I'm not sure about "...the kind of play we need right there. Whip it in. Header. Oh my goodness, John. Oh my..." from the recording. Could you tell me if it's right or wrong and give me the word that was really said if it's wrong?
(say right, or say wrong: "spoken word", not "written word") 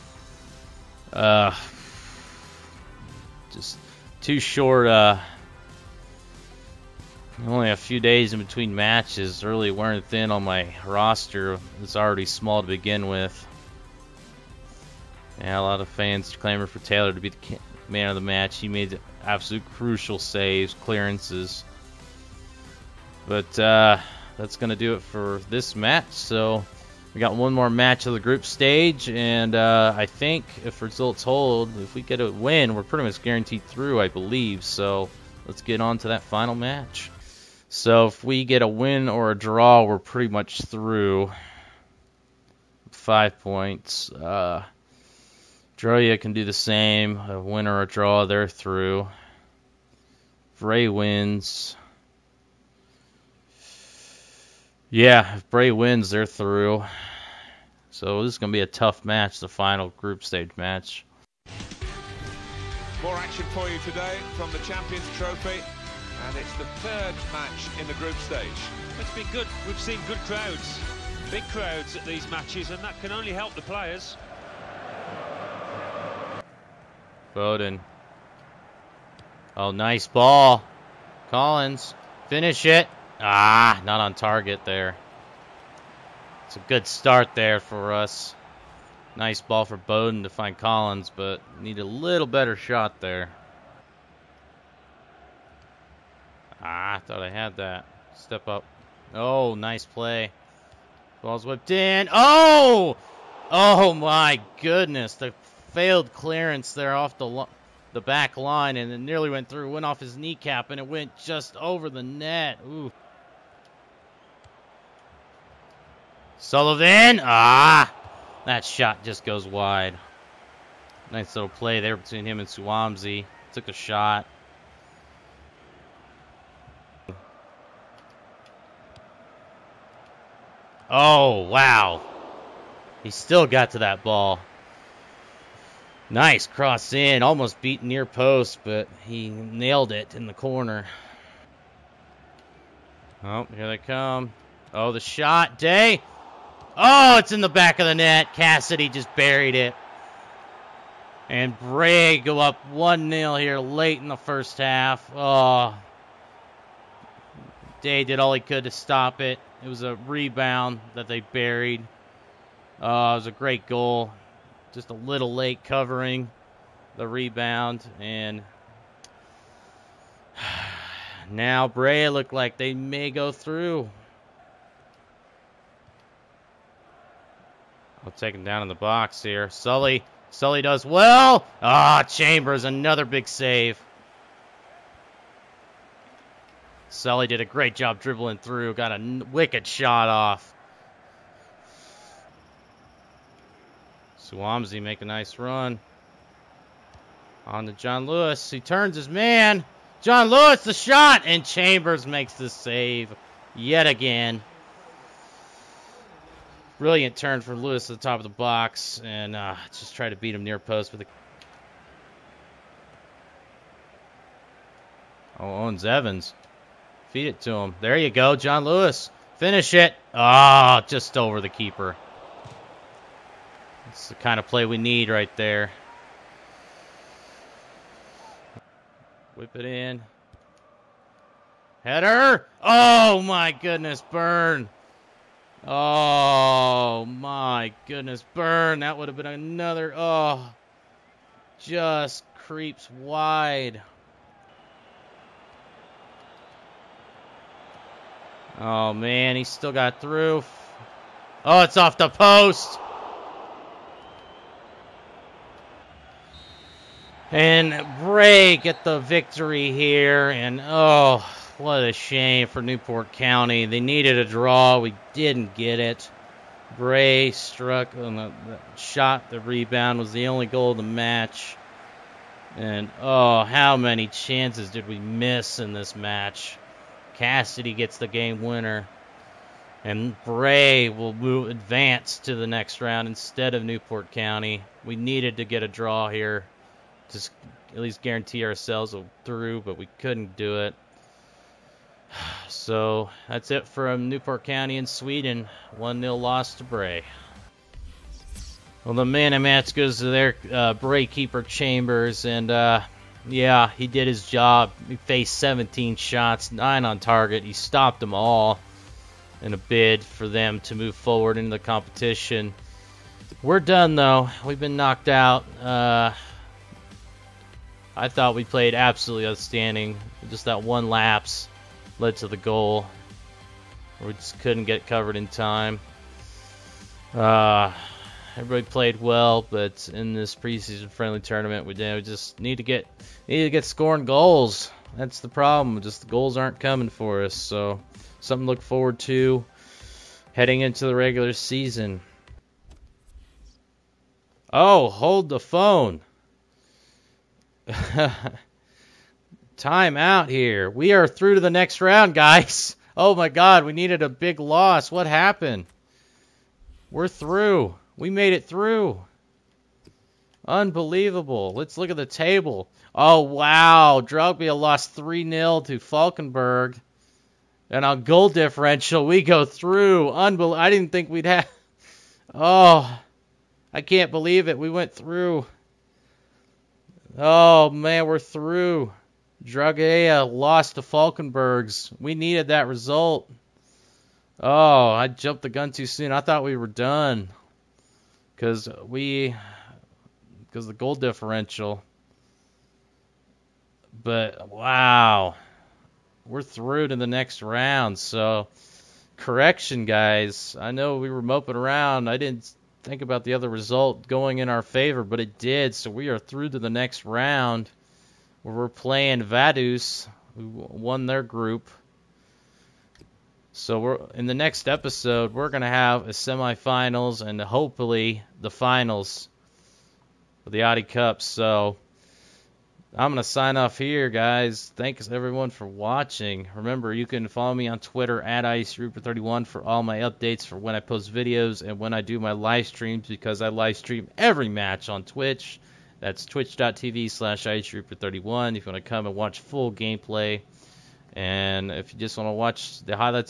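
wrong: "Burn", not "John".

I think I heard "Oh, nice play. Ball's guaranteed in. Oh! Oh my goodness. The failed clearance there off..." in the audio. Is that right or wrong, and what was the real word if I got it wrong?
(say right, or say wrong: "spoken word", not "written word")
wrong: "whipped", not "guaranteed".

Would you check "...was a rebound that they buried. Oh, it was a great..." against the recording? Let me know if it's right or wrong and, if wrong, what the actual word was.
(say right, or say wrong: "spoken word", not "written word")
right.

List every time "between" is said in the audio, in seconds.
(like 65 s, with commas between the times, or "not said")
8 s, 121 s.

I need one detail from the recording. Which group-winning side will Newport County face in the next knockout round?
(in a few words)
Vaduz.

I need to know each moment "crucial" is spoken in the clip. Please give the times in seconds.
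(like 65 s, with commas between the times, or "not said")
19 s.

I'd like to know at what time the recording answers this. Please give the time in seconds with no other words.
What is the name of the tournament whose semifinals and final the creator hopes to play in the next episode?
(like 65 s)
420 s.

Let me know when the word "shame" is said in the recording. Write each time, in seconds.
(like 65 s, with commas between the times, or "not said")
261 s.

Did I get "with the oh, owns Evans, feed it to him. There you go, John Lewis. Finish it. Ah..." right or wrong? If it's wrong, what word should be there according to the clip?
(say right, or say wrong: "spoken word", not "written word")
right.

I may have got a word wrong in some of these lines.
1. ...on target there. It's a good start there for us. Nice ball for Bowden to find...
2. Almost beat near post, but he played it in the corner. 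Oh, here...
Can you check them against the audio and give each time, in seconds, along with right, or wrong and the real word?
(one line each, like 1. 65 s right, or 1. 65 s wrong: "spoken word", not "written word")
1. 84 s right
2. 137 s wrong: "nailed", not "played".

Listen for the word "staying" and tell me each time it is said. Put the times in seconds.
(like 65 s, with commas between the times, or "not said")
not said.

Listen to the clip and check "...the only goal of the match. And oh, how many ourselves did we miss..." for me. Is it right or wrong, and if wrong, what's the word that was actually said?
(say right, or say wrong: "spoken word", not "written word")
wrong: "chances", not "ourselves".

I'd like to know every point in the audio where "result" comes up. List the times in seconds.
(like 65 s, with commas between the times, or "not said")
30 s, 382 s, 403 s.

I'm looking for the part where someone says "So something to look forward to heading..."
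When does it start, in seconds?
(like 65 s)
337 s.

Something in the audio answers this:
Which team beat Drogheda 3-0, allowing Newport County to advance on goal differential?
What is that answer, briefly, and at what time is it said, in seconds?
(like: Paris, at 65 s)
Falkenberg, at 365 s.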